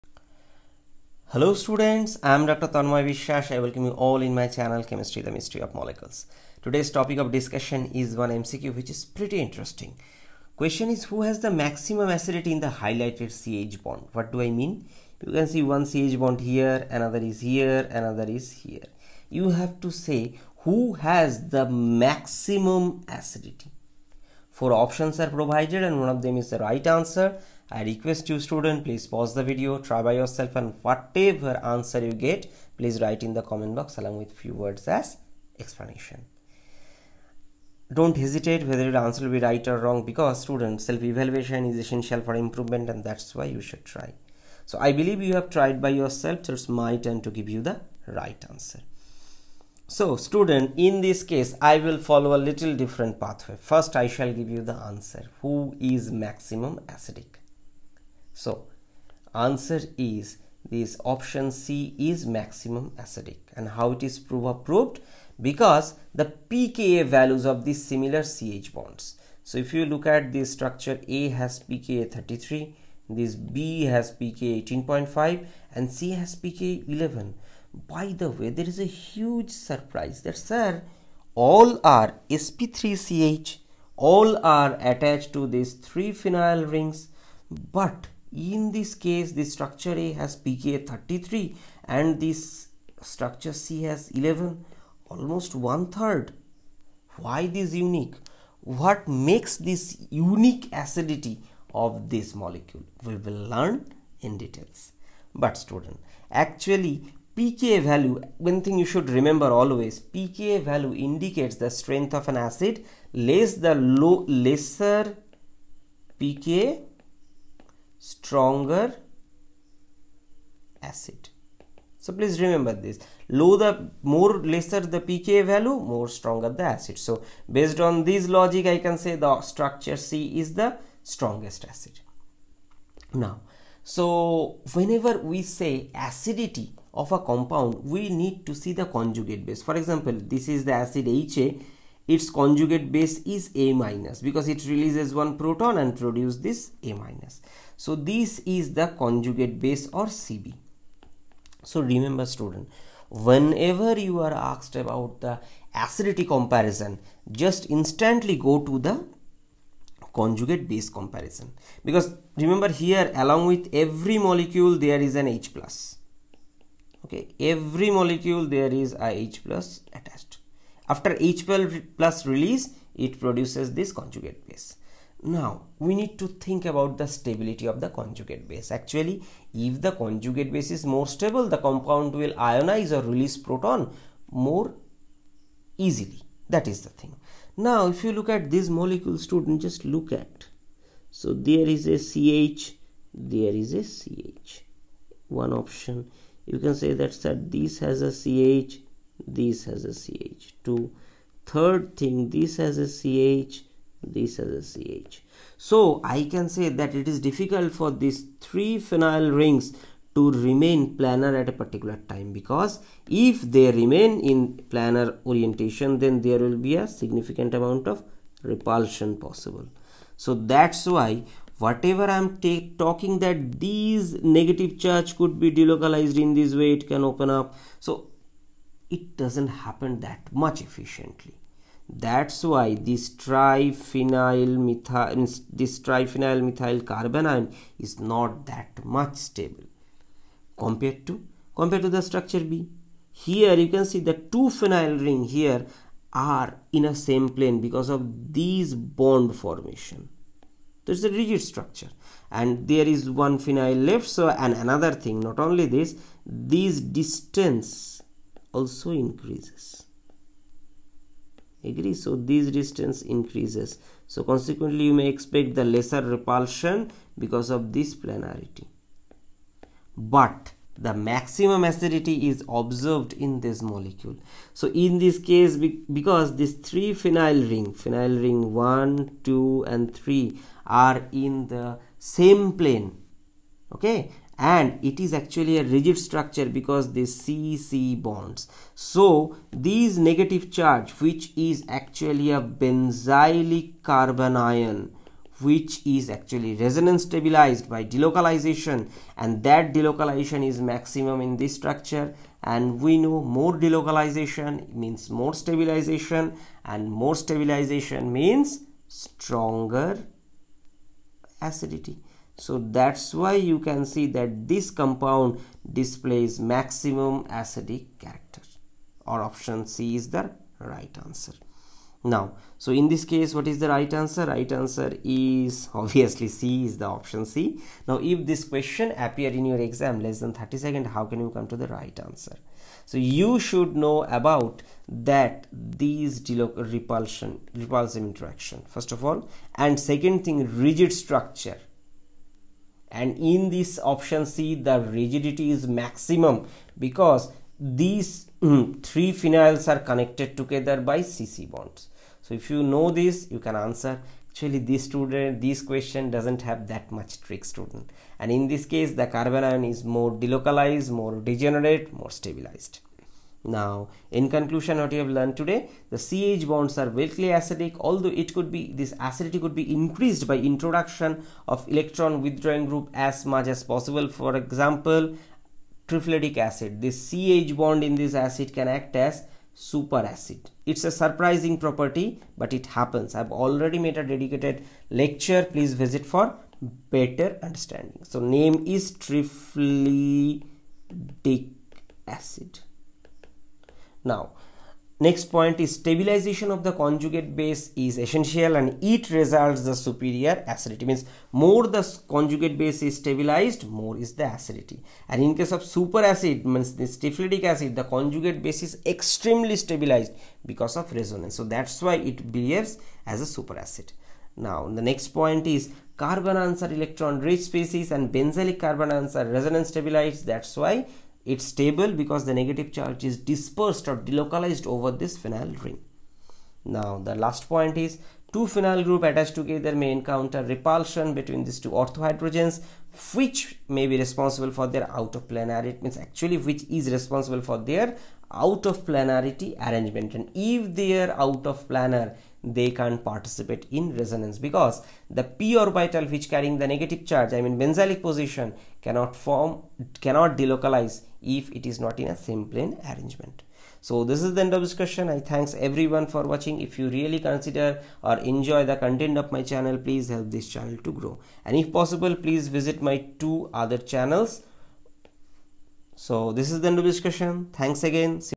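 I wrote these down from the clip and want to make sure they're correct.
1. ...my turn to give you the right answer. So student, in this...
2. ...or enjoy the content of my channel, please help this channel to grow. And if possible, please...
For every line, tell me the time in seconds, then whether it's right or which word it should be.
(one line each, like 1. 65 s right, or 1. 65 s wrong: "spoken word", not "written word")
1. 46 s right
2. 458 s right.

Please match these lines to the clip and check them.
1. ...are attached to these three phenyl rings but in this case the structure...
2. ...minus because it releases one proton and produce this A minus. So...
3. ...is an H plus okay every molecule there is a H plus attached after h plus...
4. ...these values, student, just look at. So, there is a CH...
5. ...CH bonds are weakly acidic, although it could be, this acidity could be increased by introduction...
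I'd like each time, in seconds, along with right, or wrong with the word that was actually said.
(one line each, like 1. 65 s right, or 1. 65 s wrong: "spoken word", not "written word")
1. 84 s right
2. 143 s right
3. 164 s right
4. 188 s wrong: "molecules", not "values"
5. 365 s right.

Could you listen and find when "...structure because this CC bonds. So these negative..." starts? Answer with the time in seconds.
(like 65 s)
285 s.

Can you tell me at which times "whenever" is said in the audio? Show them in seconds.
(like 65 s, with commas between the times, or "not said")
134 s, 153 s.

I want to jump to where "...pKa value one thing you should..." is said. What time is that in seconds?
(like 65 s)
107 s.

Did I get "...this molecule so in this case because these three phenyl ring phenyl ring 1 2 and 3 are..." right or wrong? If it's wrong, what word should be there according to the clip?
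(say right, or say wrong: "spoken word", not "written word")
right.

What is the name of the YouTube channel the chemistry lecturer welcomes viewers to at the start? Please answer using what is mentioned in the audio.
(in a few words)
Chemistry the Mystery of Molecules.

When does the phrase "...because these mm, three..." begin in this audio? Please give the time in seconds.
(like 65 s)
346 s.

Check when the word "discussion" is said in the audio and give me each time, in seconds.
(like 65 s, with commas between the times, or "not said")
7 s, 454 s, 466 s.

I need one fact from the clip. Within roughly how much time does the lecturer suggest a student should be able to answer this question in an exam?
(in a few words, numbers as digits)
30 seconds.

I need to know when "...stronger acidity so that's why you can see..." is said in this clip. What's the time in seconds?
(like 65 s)
308 s.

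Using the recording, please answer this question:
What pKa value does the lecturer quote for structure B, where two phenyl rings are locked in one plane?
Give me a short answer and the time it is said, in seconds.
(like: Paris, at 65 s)
18.5, at 74 s.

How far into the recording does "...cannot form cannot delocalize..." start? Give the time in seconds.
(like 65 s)
448 s.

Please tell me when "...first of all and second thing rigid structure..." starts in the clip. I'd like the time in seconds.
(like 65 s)
338 s.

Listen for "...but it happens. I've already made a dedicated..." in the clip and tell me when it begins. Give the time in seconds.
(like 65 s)
382 s.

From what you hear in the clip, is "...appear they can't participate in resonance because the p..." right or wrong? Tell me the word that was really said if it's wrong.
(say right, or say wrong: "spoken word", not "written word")
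wrong: "planar", not "appear".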